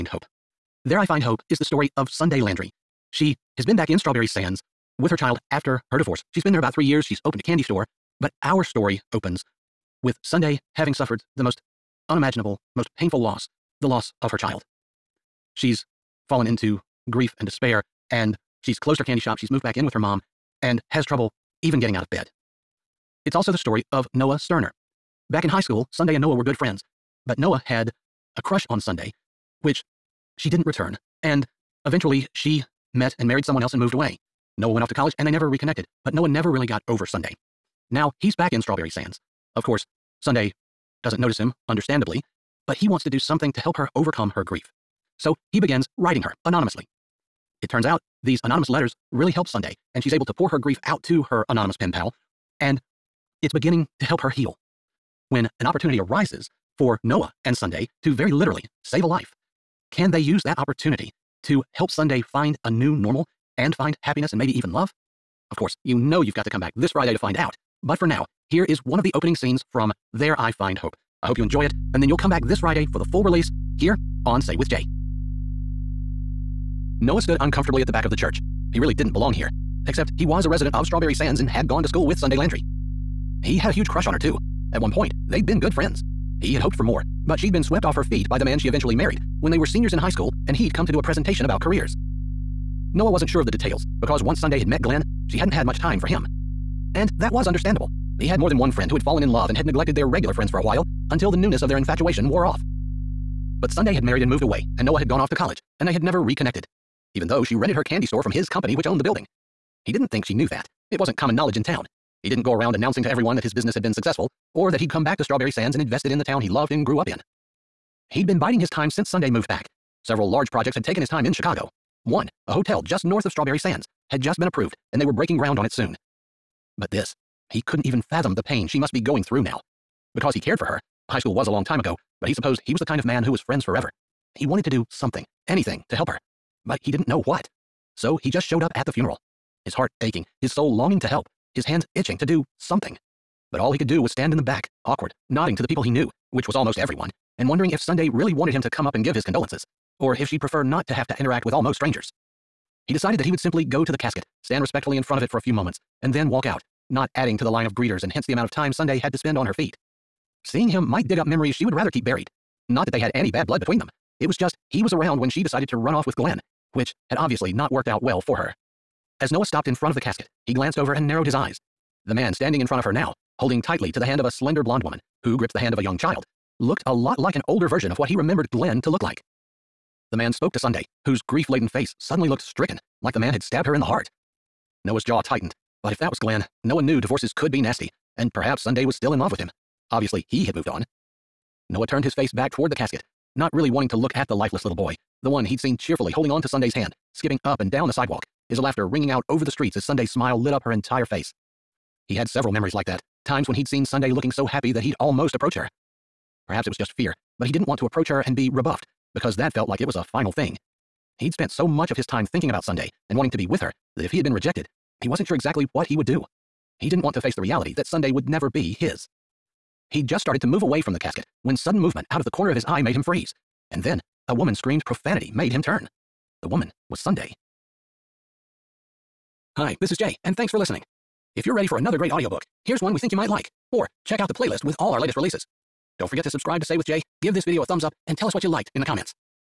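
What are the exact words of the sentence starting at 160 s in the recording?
Seeing him might dig up memories she would rather keep buried.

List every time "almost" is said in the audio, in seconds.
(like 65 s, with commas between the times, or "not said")
146 s, 151 s, 204 s.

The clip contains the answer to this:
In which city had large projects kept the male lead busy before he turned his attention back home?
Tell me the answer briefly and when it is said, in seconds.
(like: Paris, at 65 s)
Chicago, at 121 s.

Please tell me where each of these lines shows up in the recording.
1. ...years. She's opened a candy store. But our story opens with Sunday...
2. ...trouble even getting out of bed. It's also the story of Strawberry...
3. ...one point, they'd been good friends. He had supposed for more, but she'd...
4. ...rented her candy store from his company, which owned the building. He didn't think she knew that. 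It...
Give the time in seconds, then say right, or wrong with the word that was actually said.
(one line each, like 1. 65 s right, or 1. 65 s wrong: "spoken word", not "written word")
1. 6 s right
2. 21 s wrong: "Noah", not "Strawberry"
3. 84 s wrong: "hoped", not "supposed"
4. 107 s right.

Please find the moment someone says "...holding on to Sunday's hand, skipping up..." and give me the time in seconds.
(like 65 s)
196 s.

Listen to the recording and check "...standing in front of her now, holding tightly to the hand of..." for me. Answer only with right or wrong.
right.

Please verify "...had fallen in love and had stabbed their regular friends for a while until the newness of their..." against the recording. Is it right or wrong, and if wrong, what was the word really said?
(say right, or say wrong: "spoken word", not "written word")
wrong: "neglected", not "stabbed".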